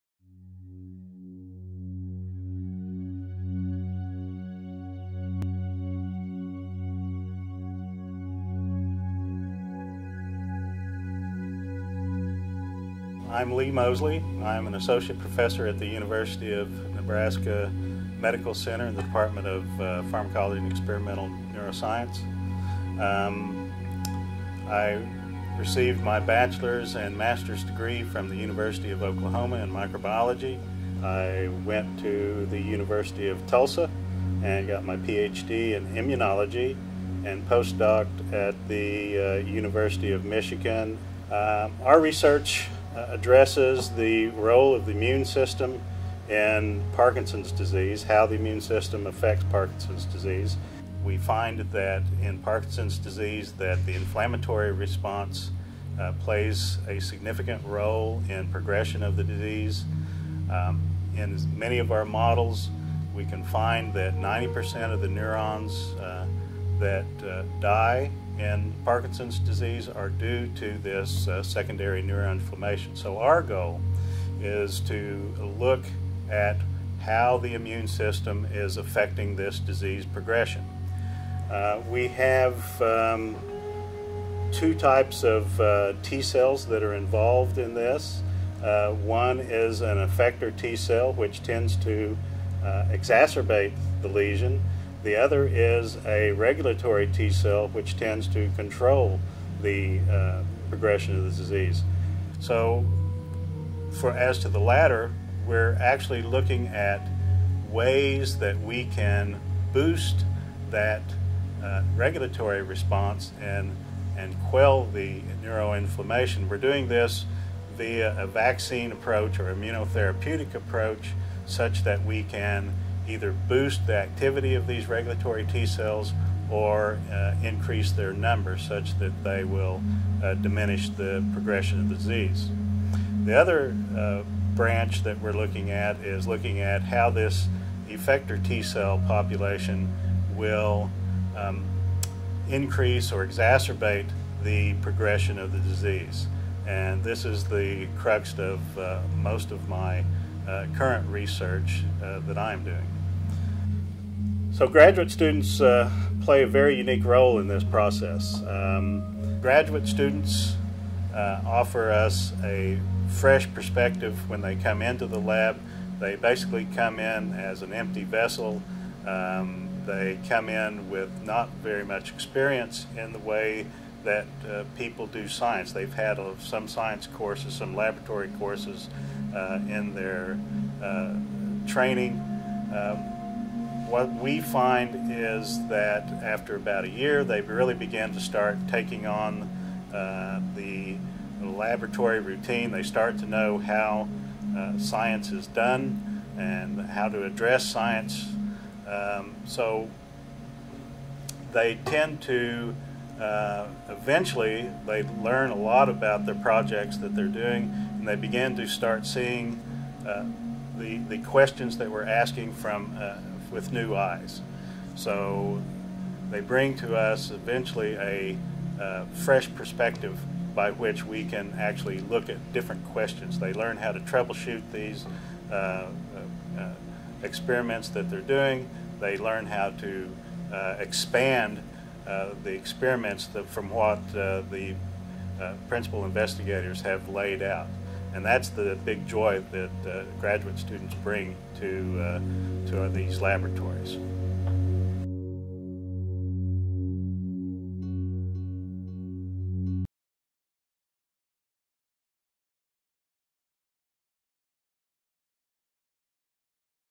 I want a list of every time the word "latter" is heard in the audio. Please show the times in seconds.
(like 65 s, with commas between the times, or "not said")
104 s.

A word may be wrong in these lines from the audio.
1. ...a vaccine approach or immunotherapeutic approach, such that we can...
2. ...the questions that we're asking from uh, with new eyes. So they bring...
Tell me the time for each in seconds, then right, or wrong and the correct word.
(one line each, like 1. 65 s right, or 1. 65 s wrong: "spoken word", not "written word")
1. 118 s right
2. 210 s right.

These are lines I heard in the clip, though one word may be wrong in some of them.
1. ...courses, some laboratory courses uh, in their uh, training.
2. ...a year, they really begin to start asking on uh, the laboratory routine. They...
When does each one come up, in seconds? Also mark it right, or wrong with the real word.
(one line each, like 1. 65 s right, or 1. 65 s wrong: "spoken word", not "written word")
1. 177 s right
2. 186 s wrong: "taking", not "asking".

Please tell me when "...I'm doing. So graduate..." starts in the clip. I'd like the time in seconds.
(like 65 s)
152 s.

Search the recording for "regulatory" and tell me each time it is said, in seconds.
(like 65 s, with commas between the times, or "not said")
96 s, 111 s, 124 s.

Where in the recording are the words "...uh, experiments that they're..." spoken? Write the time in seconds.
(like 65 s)
226 s.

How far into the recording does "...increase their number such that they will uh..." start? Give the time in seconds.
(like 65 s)
127 s.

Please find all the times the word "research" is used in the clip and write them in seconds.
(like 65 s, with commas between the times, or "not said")
42 s, 151 s.